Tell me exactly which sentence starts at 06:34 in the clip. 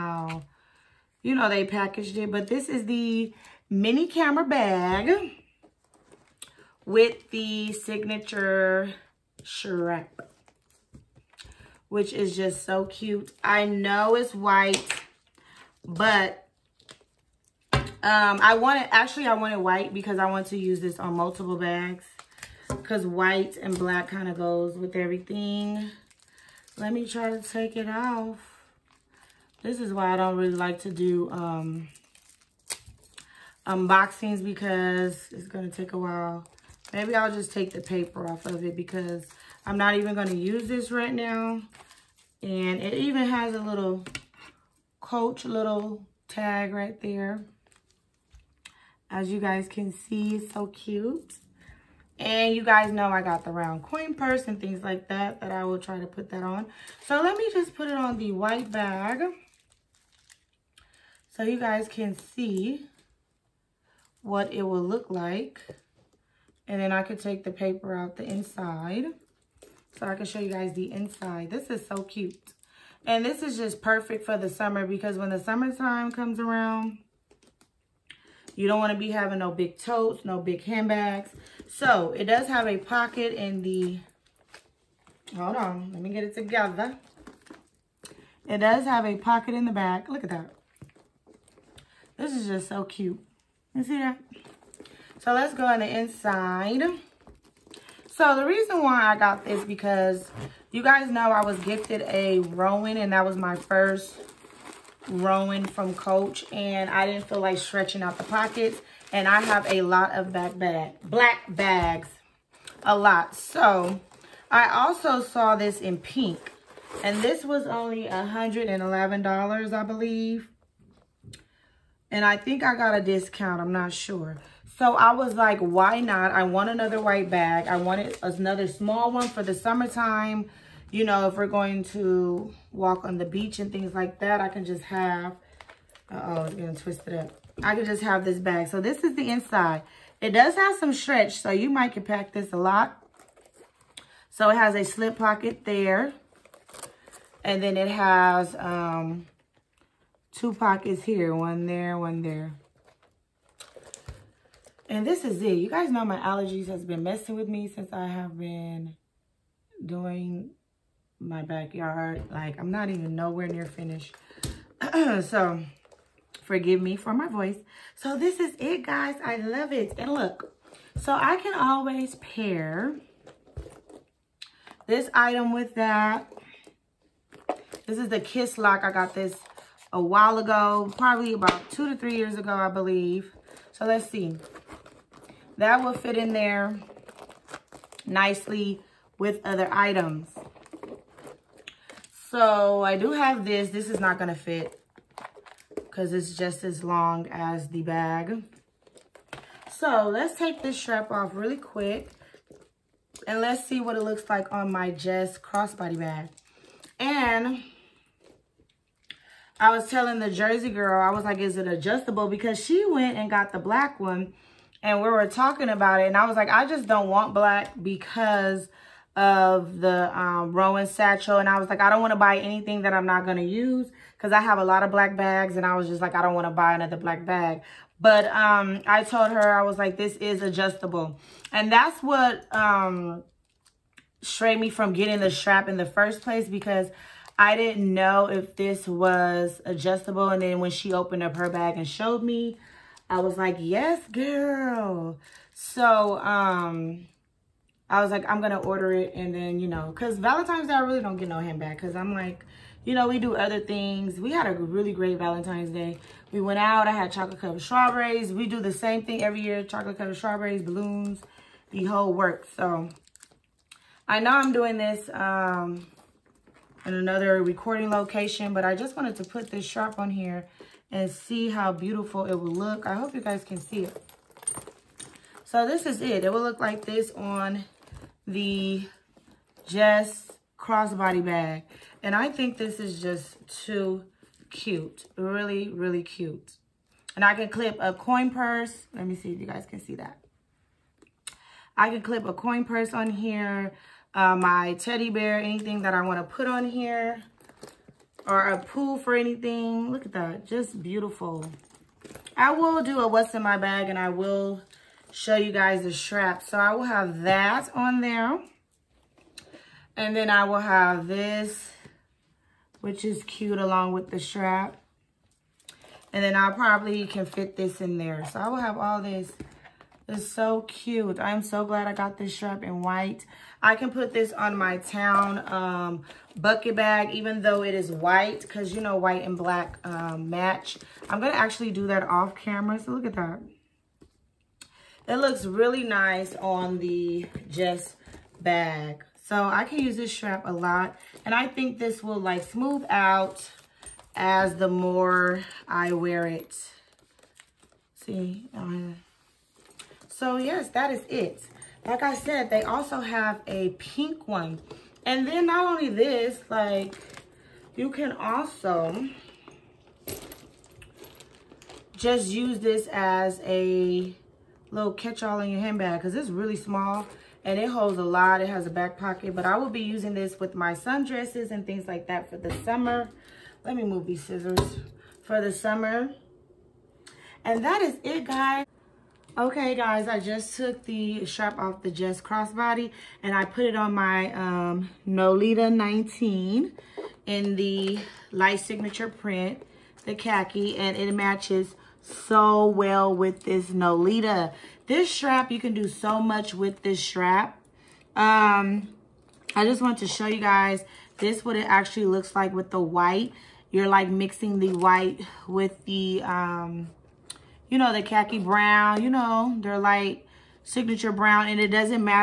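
This strap, you can do so much with this strap.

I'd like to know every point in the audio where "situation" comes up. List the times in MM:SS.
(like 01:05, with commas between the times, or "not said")
not said.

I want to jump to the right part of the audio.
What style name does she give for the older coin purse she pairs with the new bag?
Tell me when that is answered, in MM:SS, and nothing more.
02:58.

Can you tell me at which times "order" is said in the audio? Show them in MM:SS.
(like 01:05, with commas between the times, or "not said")
04:08.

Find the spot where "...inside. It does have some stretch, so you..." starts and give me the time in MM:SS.
02:19.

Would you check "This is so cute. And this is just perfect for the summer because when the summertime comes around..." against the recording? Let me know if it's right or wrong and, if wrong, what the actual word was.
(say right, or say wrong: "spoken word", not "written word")
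right.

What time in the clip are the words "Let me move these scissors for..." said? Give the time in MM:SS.
06:13.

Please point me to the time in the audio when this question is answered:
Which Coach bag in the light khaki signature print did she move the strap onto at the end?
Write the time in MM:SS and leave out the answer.
06:25.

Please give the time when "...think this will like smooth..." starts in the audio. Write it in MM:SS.
05:41.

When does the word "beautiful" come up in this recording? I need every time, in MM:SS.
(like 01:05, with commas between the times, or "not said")
04:31, 05:00.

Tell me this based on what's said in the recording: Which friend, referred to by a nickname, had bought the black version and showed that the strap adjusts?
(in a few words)
the Jersey girl.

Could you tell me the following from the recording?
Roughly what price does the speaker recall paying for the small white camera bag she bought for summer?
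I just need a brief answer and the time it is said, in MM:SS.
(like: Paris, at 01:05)
$111, at 01:58.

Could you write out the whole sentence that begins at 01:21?
So it does have a pocket in the, hold on, let me get it together.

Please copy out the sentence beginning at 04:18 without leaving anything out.
We do the same thing every year.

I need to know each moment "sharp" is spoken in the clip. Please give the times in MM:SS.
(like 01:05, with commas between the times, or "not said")
04:29, 05:22.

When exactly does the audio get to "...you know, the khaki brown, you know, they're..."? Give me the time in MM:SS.
06:47.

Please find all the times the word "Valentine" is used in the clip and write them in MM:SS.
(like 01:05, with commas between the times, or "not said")
04:10, 04:15.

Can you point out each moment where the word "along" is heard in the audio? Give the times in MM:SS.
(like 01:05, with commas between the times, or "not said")
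05:13.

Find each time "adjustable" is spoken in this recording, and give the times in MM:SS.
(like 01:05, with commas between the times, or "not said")
03:31, 03:50, 03:59.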